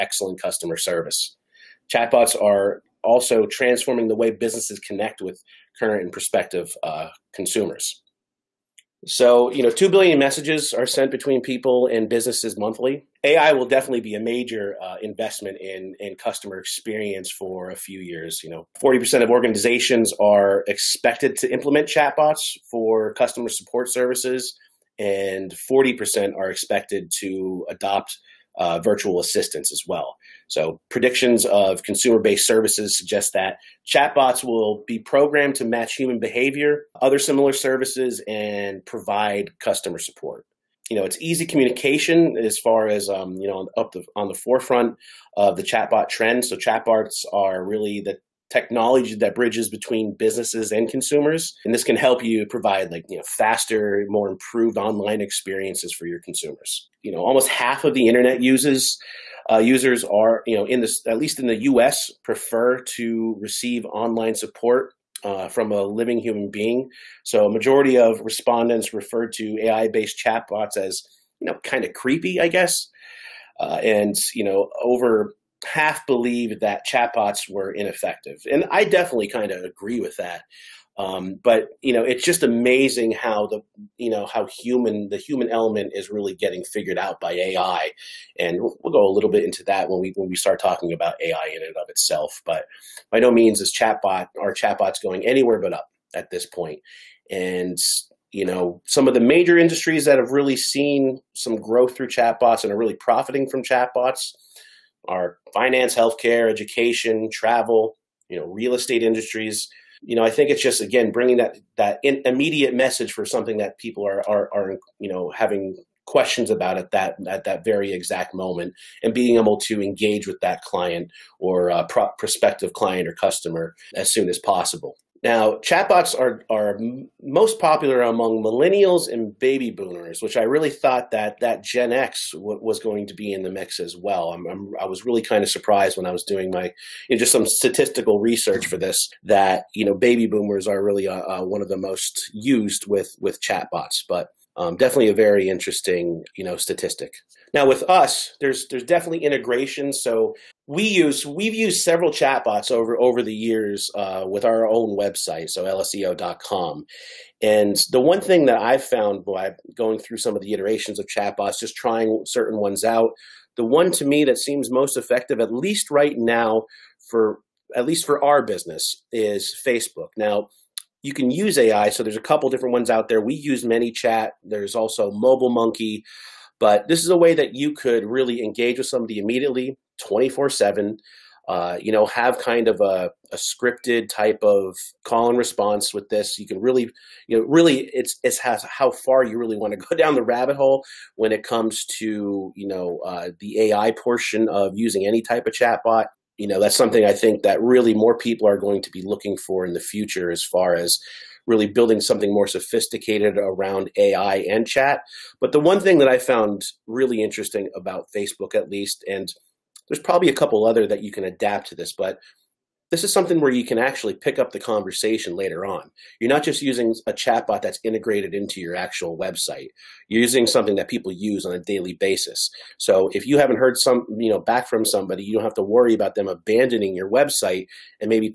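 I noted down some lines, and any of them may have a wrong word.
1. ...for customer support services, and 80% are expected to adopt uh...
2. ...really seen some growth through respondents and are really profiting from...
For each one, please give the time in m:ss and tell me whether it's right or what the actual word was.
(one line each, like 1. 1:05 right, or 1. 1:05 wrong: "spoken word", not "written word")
1. 0:22 wrong: "40", not "80"
2. 1:40 wrong: "chatbots", not "respondents".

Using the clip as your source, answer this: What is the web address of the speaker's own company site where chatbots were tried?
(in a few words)
lseo.com.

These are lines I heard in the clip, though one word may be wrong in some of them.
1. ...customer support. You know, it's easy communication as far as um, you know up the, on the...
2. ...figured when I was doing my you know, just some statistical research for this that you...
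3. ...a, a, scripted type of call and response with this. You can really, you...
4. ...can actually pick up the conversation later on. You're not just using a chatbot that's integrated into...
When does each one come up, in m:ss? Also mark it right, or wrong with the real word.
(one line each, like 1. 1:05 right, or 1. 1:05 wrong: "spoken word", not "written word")
1. 0:39 right
2. 2:15 wrong: "surprised", not "figured"
3. 3:02 right
4. 3:33 right.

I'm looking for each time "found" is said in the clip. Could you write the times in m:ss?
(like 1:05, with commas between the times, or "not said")
2:38, 3:26.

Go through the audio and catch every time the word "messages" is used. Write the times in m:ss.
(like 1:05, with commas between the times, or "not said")
0:10, 1:52.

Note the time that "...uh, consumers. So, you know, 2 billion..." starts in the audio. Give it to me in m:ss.
0:06.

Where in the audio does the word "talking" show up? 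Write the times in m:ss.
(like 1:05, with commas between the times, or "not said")
1:30.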